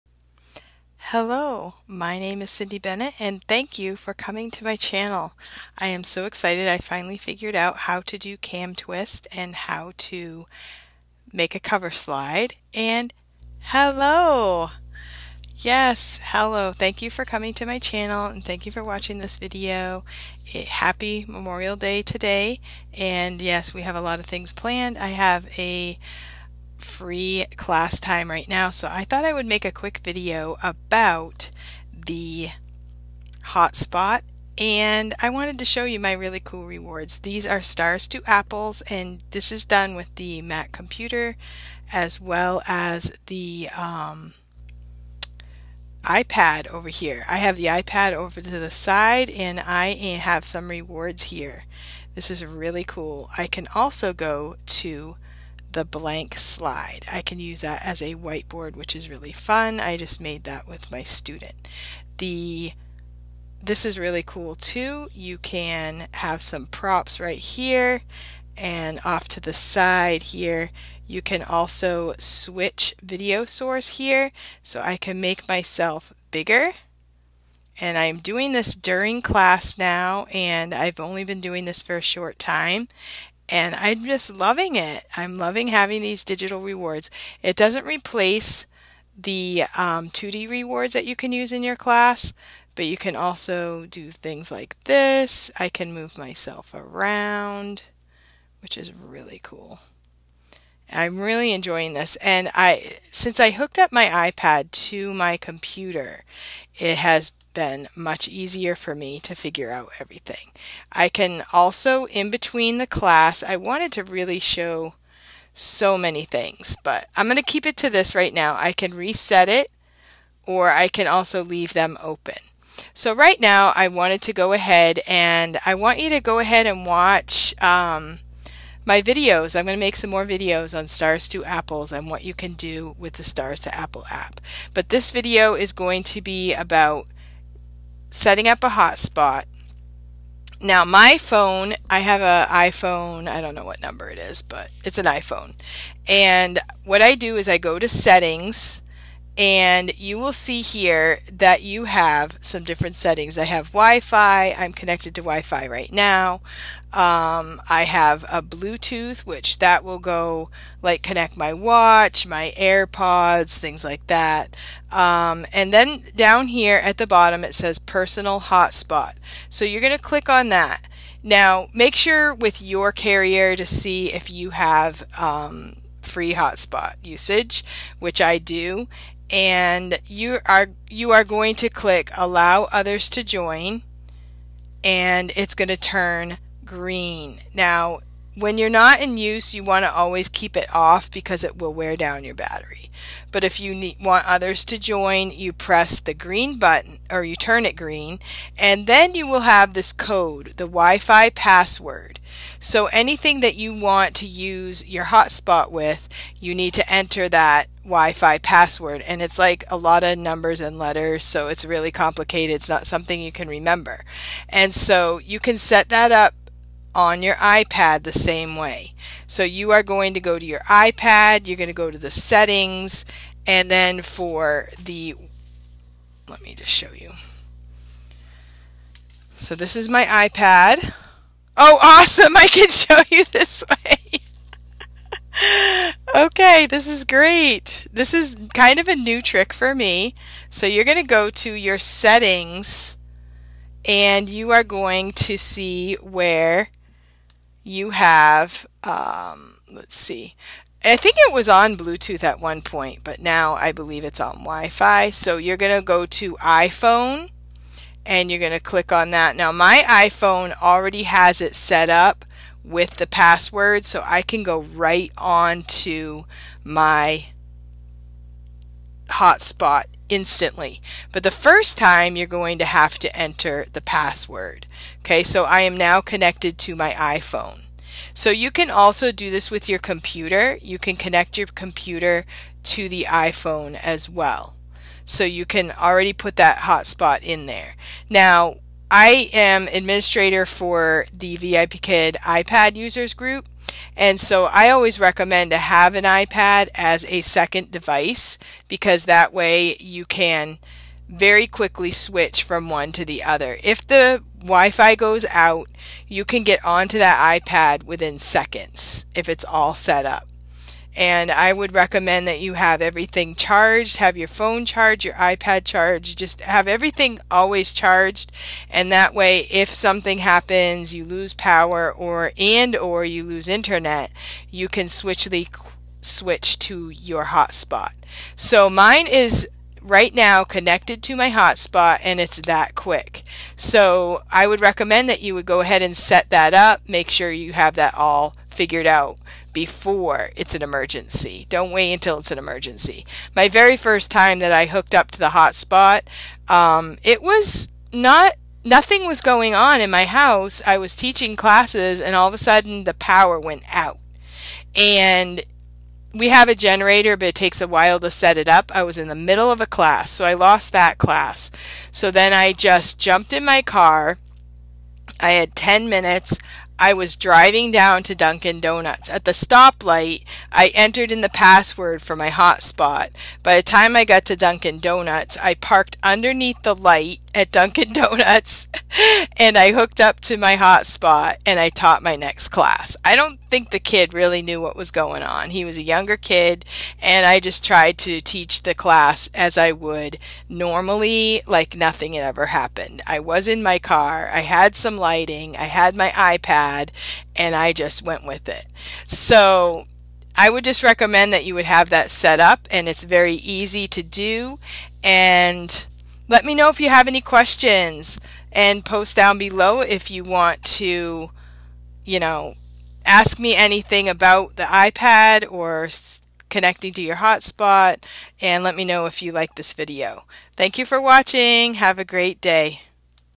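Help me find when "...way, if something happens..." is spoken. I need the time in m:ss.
5:19.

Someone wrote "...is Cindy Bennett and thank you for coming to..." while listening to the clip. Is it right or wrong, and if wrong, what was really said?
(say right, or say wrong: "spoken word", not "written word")
right.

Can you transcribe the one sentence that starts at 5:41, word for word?
Don't wait until it's an emergency.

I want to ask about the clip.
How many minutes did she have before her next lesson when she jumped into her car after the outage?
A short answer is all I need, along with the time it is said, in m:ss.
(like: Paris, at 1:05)
10 minutes, at 6:05.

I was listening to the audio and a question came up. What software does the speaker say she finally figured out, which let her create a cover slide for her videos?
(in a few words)
CamTwist.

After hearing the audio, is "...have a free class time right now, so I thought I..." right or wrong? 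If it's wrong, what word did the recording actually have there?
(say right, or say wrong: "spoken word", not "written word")
right.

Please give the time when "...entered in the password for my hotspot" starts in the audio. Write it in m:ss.
6:10.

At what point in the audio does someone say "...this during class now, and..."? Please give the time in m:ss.
1:18.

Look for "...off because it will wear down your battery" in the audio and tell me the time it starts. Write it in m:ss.
3:10.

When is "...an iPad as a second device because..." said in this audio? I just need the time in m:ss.
4:55.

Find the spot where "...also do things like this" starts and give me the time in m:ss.
1:33.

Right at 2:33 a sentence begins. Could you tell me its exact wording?
I have Wi-Fi, I'm connected to Wi-Fi right now.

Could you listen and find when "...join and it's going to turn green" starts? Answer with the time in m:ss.
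3:03.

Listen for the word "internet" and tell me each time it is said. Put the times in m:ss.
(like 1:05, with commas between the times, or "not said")
5:23.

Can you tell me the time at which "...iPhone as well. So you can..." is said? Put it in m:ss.
4:43.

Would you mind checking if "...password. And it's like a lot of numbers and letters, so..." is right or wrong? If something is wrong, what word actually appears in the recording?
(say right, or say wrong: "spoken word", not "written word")
right.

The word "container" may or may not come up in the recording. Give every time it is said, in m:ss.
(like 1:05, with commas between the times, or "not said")
not said.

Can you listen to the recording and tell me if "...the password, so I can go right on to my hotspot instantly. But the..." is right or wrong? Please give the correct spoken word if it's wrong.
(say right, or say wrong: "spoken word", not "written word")
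right.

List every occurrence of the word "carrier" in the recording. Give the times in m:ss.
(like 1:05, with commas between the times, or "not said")
2:52.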